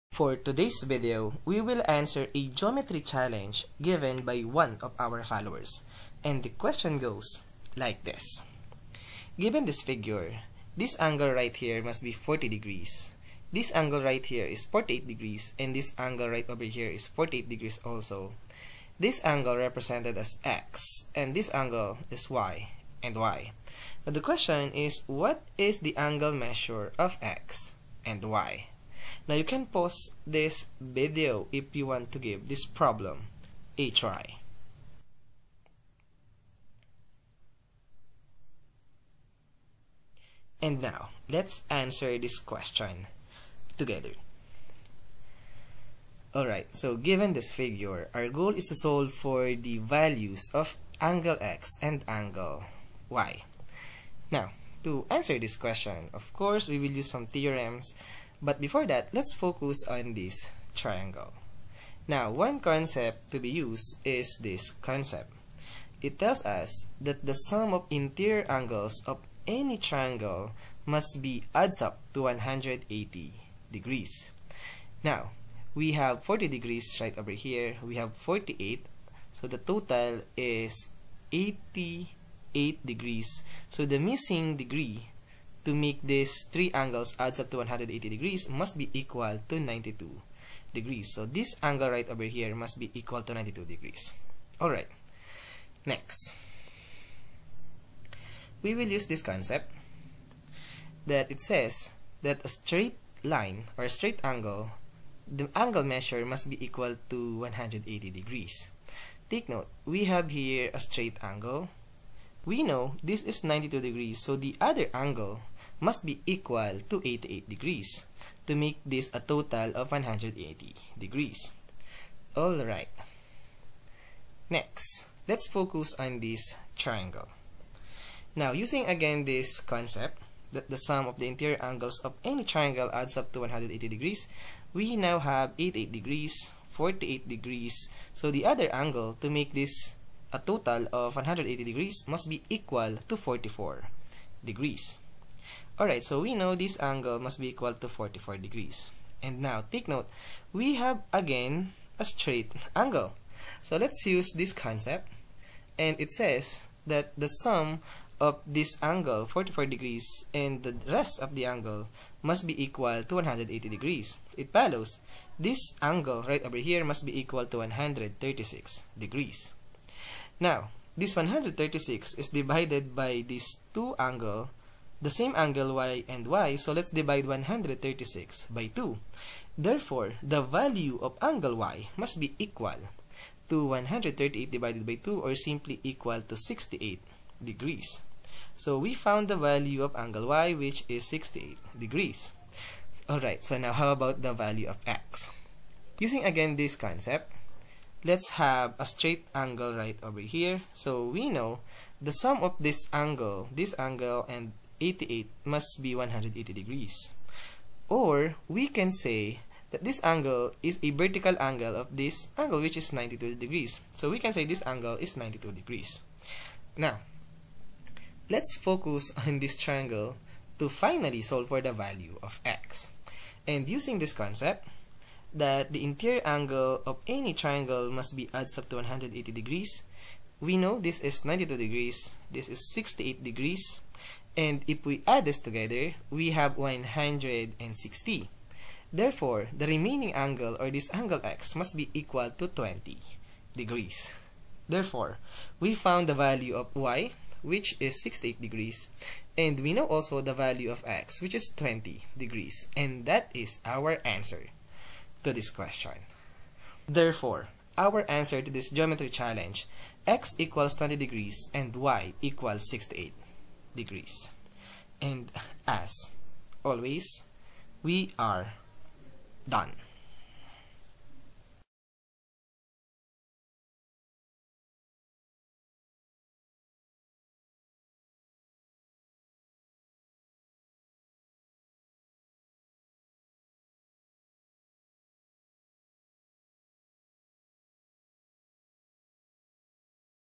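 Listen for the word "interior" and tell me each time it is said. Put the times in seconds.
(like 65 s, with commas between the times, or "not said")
67 s, 131 s, 225 s.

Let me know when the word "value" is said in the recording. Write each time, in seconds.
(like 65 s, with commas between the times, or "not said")
49 s, 180 s, 189 s, 194 s, 221 s, 246 s, 250 s.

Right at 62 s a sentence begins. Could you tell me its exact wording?
Now, one concept to be used is this concept.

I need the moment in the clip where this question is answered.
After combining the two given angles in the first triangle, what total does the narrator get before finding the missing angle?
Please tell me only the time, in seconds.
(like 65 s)
79 s.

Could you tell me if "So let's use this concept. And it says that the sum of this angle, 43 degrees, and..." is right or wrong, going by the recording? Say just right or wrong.
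wrong.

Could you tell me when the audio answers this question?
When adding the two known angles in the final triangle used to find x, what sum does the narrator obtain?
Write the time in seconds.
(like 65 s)
236 s.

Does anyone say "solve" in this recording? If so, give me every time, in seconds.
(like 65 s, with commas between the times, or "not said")
48 s, 221 s.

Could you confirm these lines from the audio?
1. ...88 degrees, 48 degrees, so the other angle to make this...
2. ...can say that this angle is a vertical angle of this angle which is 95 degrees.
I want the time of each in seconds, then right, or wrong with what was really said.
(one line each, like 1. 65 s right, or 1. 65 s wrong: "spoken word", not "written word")
1. 135 s right
2. 208 s wrong: "92", not "95".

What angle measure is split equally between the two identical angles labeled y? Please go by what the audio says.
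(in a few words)
136 degrees.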